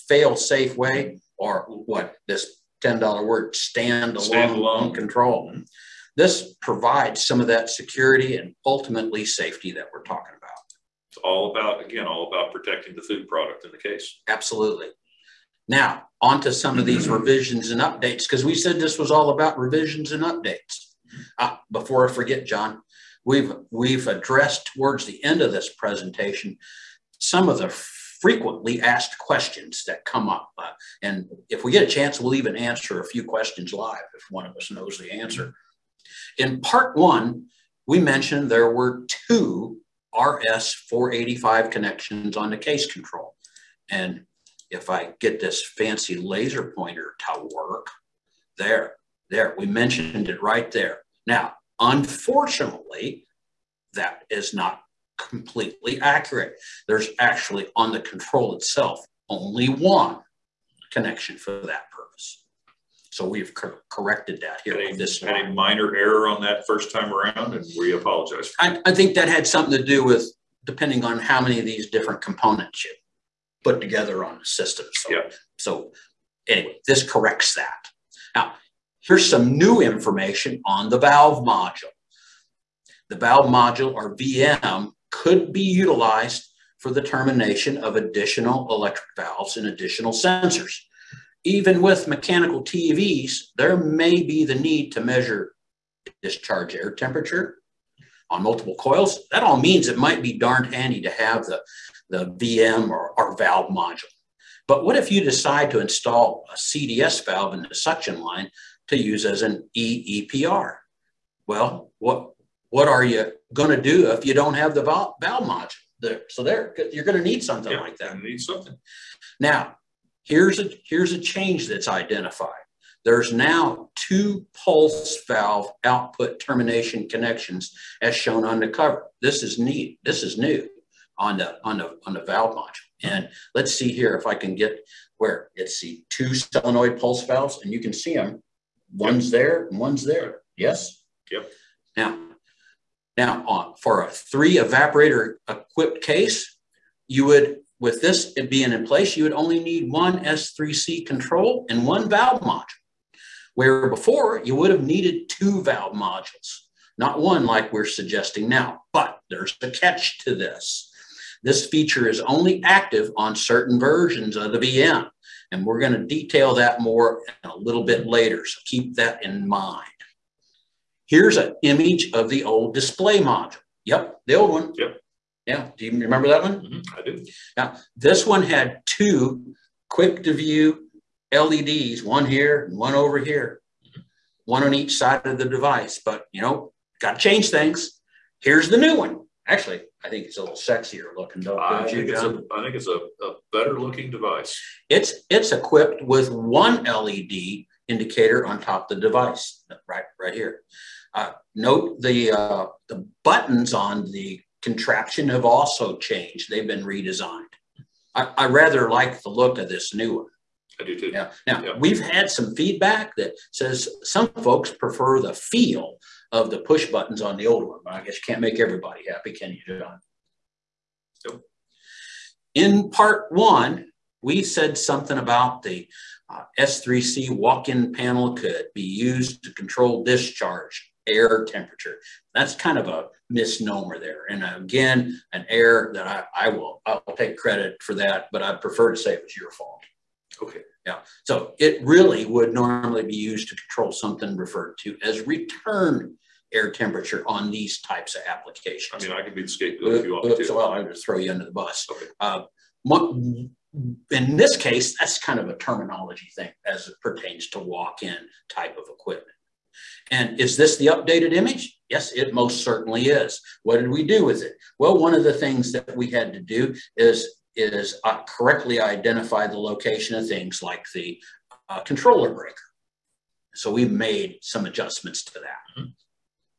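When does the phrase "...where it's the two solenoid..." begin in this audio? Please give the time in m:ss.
2:15.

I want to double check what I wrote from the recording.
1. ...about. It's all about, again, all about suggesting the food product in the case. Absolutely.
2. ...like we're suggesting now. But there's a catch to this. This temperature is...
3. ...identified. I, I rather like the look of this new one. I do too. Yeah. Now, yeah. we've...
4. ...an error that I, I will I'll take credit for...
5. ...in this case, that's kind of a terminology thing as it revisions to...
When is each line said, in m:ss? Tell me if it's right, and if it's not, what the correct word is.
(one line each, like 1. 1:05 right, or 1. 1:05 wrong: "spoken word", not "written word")
1. 0:10 wrong: "protecting", not "suggesting"
2. 2:37 wrong: "feature", not "temperature"
3. 3:26 wrong: "redesigned", not "identified"
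4. 3:55 right
5. 4:14 wrong: "pertains", not "revisions".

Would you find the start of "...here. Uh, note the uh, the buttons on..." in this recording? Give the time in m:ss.
3:20.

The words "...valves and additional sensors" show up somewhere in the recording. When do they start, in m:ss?
1:29.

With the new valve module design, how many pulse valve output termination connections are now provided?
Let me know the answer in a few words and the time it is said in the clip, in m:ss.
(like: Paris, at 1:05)
2, at 2:03.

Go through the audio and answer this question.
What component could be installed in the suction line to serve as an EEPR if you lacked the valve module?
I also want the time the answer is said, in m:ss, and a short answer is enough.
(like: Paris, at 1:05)
CDS valve, at 1:46.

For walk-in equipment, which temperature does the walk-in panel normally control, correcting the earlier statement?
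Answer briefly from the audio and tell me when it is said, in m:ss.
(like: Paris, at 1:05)
Return air temperature, at 4:05.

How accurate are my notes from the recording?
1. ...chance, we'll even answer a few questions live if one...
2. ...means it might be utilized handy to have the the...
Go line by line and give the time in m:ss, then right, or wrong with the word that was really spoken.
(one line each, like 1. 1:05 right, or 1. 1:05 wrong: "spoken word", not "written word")
1. 0:31 right
2. 1:39 wrong: "darned", not "utilized".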